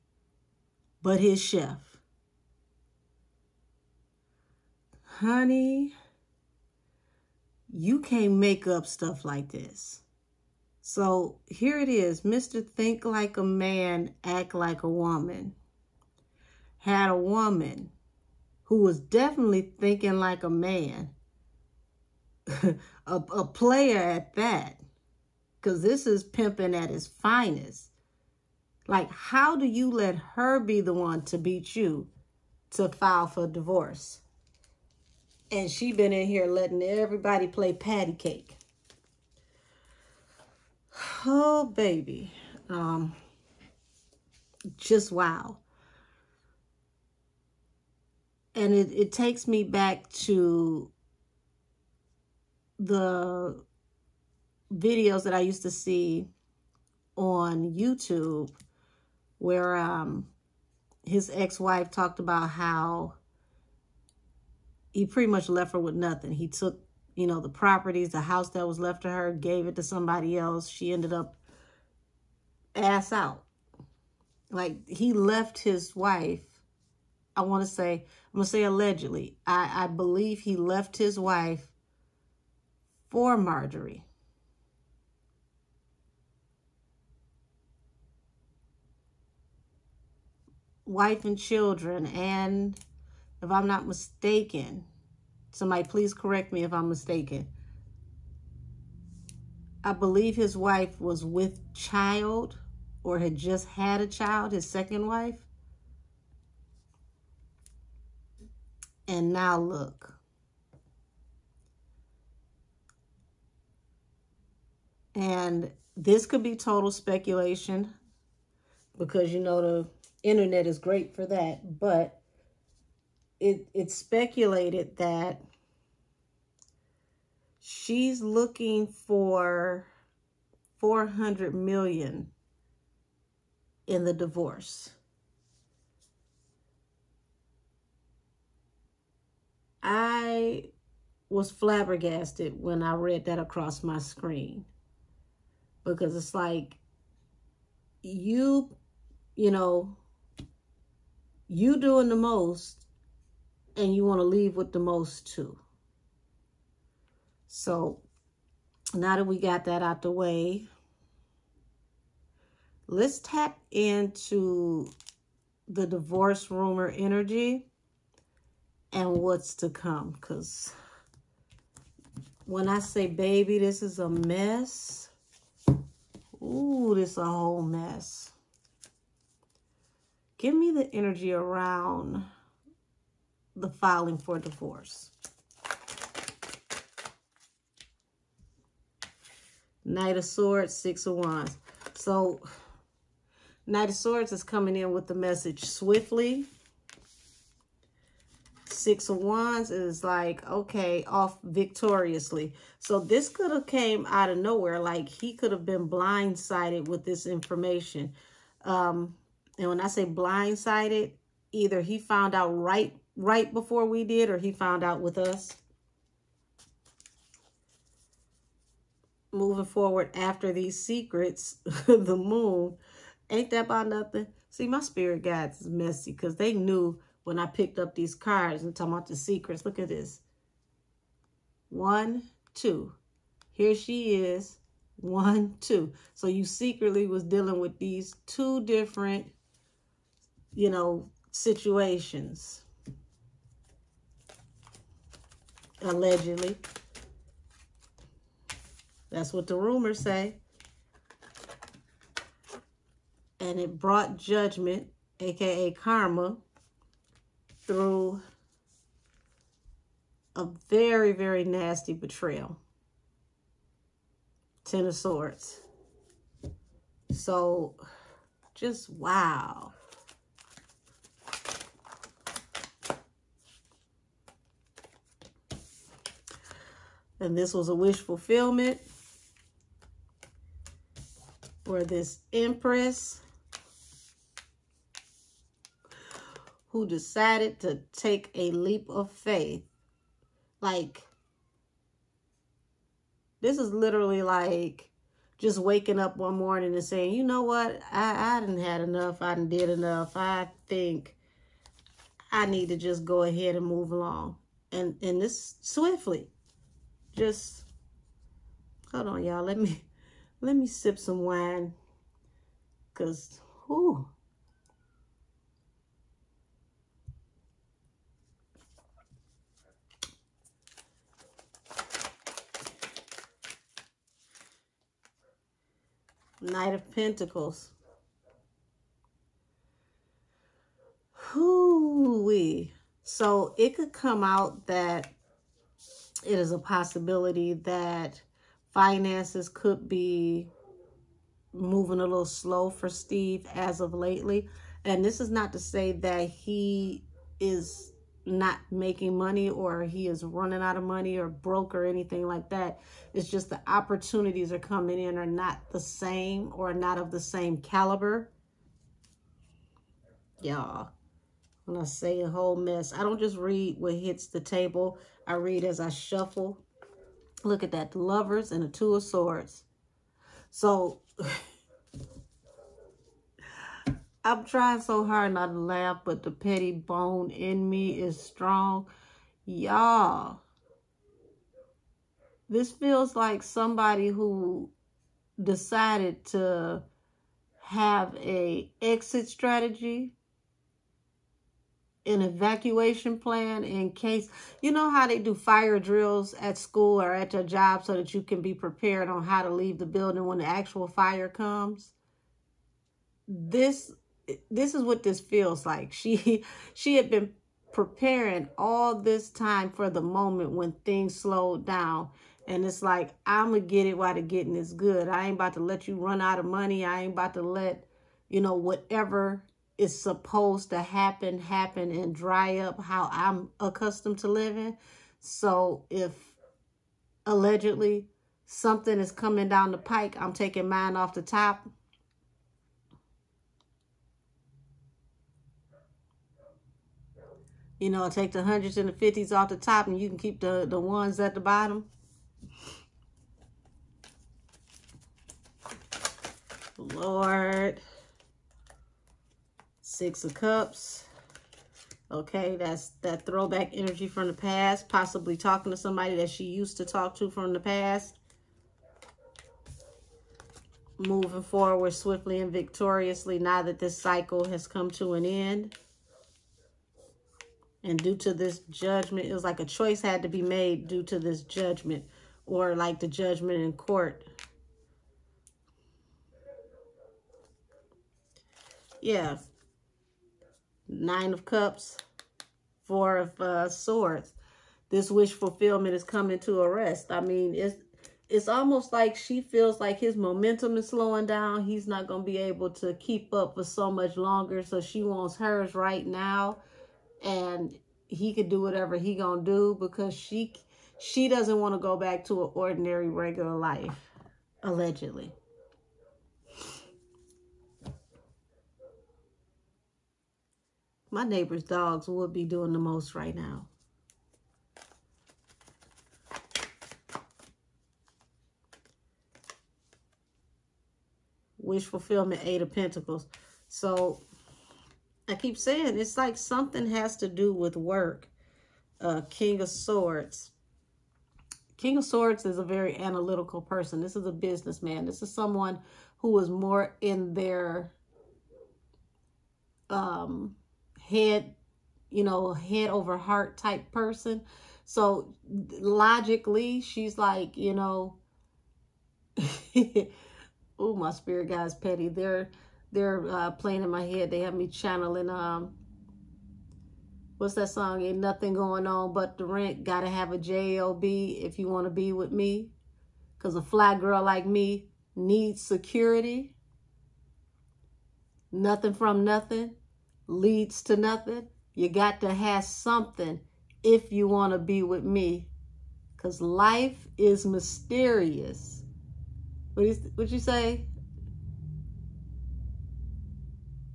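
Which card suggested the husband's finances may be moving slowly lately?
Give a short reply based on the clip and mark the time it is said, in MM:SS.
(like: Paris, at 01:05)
Knight of Pentacles, at 05:26.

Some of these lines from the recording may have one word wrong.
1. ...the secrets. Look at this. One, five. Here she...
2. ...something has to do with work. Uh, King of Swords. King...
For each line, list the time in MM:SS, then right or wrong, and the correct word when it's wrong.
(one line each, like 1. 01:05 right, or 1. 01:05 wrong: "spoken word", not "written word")
1. 03:49 wrong: "two", not "five"
2. 08:46 right.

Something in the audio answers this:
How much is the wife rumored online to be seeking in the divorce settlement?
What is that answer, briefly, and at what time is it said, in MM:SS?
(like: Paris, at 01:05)
400 million, at 02:10.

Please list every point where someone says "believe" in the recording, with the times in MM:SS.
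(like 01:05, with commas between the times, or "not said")
01:19, 01:39.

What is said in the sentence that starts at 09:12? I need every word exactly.
They're they're uh, playing in my head.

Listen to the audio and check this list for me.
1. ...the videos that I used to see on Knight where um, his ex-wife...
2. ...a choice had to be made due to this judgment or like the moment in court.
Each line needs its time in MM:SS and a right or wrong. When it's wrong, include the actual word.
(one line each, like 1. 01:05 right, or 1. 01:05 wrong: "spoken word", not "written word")
1. 00:52 wrong: "YouTube", not "Knight"
2. 07:49 wrong: "judgment", not "moment".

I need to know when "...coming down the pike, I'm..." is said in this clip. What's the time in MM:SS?
07:09.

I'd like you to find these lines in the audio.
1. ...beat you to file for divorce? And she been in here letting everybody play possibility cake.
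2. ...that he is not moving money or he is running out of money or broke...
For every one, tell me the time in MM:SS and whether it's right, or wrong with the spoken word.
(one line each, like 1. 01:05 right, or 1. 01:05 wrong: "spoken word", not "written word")
1. 00:31 wrong: "patty", not "possibility"
2. 05:45 wrong: "making", not "moving".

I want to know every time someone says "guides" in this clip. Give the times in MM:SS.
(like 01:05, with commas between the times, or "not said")
03:45.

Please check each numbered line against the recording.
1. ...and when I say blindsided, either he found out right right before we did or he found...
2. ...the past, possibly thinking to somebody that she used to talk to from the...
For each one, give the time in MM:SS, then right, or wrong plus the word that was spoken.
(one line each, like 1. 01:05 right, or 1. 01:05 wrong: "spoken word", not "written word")
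1. 03:29 right
2. 07:34 wrong: "talking", not "thinking".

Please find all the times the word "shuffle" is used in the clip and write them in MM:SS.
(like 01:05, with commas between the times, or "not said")
06:05.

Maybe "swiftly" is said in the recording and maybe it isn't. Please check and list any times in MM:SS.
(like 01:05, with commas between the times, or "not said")
03:15, 05:05, 07:41.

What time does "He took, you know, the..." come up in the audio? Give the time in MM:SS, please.
01:06.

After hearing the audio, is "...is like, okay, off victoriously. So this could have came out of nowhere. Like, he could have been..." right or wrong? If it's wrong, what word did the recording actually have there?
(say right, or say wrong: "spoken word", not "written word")
right.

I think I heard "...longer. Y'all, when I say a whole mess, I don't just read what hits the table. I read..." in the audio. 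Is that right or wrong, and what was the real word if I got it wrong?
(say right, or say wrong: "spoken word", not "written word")
wrong: "caliber", not "longer".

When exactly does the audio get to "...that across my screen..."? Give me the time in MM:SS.
02:23.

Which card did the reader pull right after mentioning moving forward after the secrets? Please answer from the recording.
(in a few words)
The Moon.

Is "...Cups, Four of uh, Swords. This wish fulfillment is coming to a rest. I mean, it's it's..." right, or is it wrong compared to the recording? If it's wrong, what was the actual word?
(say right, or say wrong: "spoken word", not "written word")
right.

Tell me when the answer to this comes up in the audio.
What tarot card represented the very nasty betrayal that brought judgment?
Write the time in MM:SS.
04:24.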